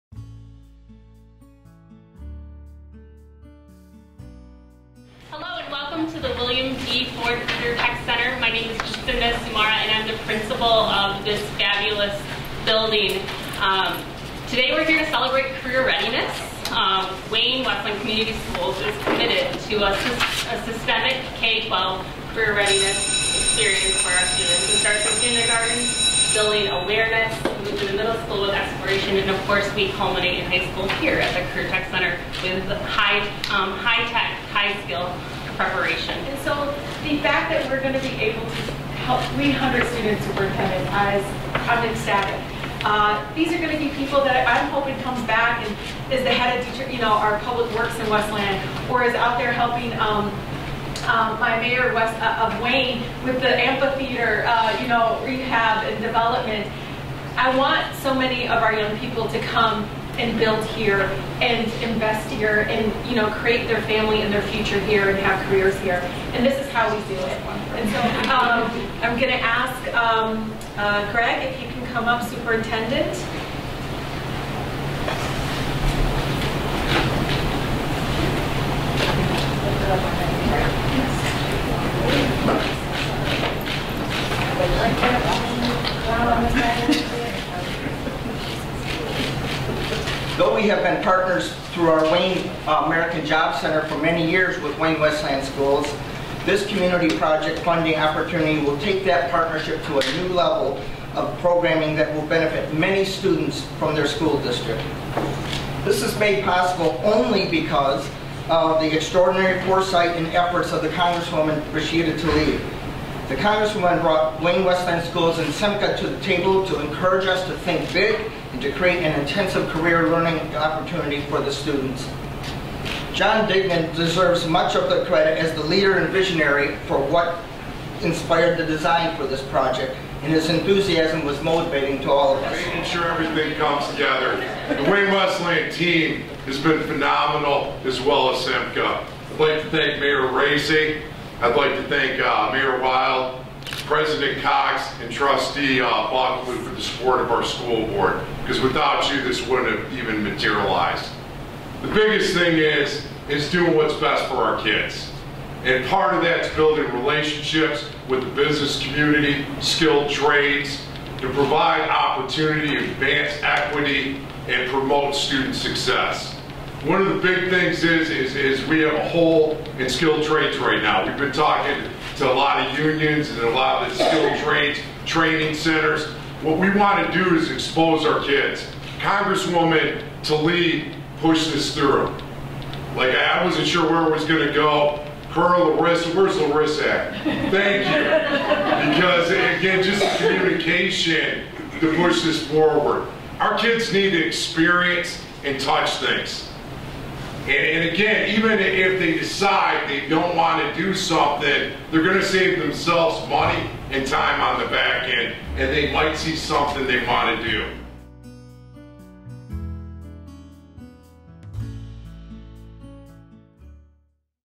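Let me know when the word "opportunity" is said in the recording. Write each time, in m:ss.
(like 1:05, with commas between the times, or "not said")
1:37, 2:00, 2:41.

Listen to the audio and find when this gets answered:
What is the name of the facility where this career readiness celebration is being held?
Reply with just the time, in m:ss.
0:06.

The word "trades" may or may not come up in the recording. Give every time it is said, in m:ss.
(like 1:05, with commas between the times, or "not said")
2:40, 2:50, 2:54.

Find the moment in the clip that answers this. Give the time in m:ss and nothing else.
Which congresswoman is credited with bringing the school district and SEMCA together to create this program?
1:51.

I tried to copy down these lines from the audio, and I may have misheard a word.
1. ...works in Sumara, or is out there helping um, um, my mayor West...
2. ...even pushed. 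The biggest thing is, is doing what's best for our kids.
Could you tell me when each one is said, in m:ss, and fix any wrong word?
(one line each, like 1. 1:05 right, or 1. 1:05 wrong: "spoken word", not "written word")
1. 0:47 wrong: "Westland", not "Sumara"
2. 2:29 wrong: "materialized", not "pushed".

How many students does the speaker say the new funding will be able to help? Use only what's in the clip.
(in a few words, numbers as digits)
300.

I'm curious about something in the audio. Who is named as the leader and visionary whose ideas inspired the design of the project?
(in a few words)
John Dignan.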